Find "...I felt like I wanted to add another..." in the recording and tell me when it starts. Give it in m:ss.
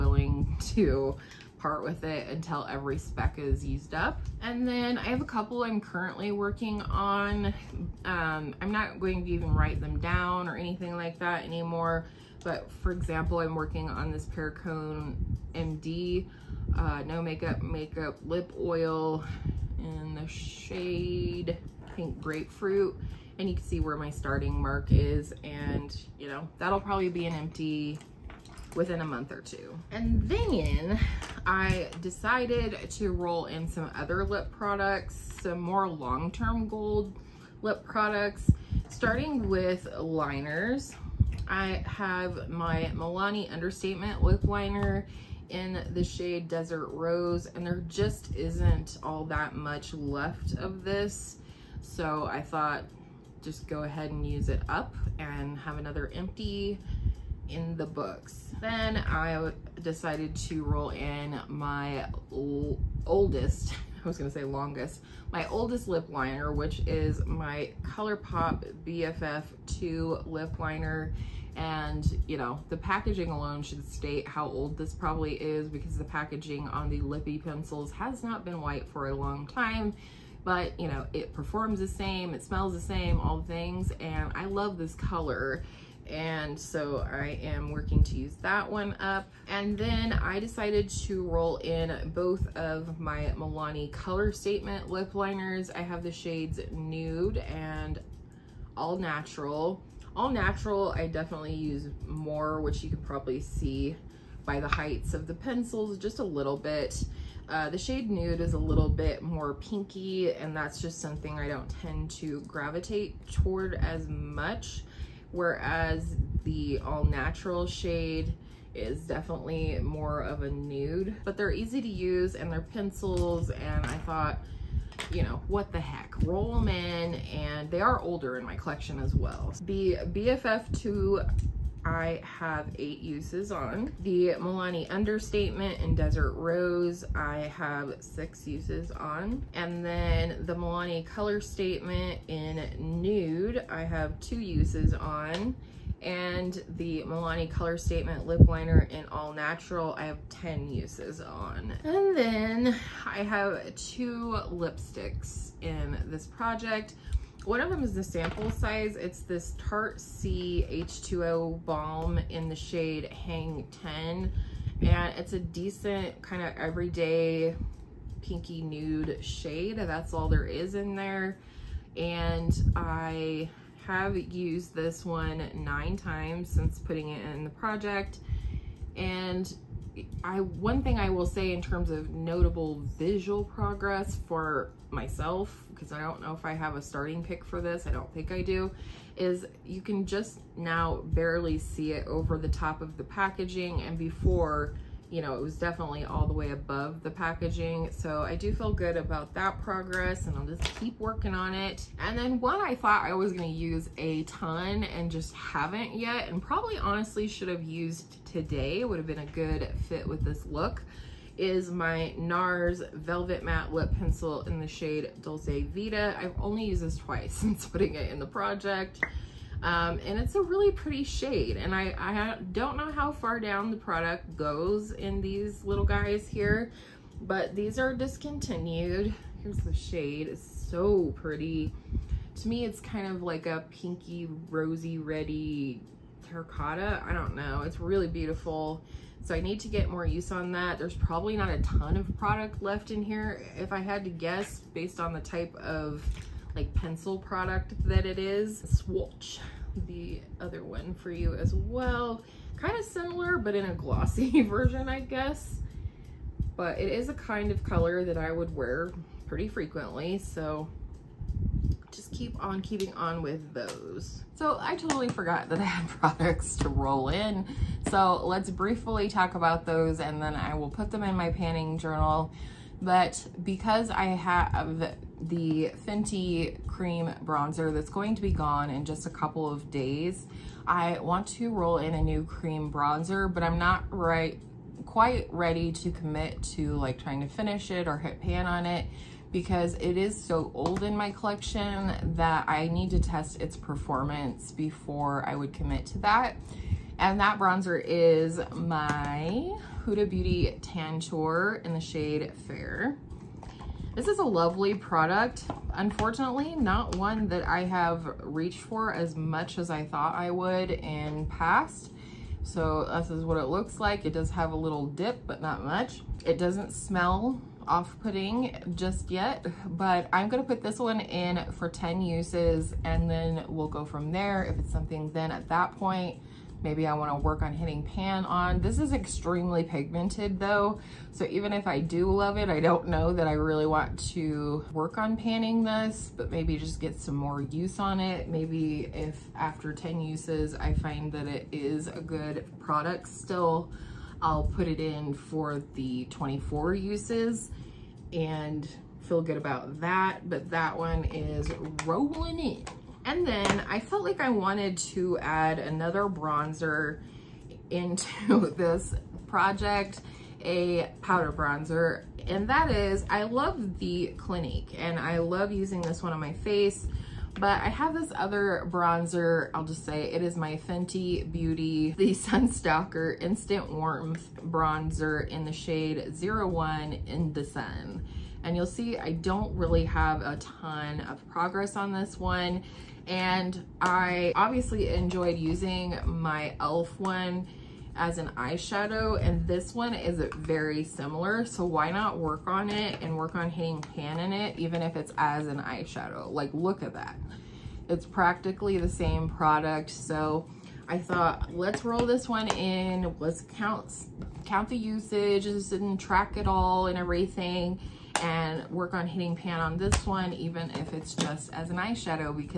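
5:53.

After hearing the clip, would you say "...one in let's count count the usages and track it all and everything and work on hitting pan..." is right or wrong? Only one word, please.
right.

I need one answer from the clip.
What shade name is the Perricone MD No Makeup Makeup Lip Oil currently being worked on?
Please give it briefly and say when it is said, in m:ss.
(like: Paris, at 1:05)
Pink Grapefruit, at 0:21.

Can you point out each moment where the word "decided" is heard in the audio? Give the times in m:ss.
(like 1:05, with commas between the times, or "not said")
0:32, 0:59, 1:30.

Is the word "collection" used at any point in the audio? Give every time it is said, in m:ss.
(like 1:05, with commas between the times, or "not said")
2:08, 4:51.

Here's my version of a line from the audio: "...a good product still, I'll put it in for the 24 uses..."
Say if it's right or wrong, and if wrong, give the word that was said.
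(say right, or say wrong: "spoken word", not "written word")
right.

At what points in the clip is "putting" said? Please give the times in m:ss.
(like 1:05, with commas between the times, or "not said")
2:56, 3:37, 5:17.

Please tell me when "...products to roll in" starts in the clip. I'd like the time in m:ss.
4:25.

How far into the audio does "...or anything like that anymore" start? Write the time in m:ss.
0:10.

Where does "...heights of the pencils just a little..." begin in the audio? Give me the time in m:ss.
1:44.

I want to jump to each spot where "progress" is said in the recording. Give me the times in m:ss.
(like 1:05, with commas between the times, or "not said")
3:03, 3:19, 6:21.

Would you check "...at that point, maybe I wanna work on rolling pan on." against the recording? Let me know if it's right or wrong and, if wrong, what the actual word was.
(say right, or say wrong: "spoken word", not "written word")
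wrong: "hitting", not "rolling".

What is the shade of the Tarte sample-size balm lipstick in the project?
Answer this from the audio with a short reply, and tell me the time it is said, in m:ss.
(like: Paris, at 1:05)
Hang 10, at 2:43.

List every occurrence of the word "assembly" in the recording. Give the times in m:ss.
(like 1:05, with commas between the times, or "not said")
not said.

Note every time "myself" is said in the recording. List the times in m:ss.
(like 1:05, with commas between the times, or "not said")
3:04.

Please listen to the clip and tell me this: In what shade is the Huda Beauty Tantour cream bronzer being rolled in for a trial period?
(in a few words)
Fair.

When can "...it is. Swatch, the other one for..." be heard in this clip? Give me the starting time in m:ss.
4:08.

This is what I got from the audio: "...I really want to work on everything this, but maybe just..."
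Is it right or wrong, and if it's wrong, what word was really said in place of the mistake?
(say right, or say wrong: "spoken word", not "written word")
wrong: "panning", not "everything".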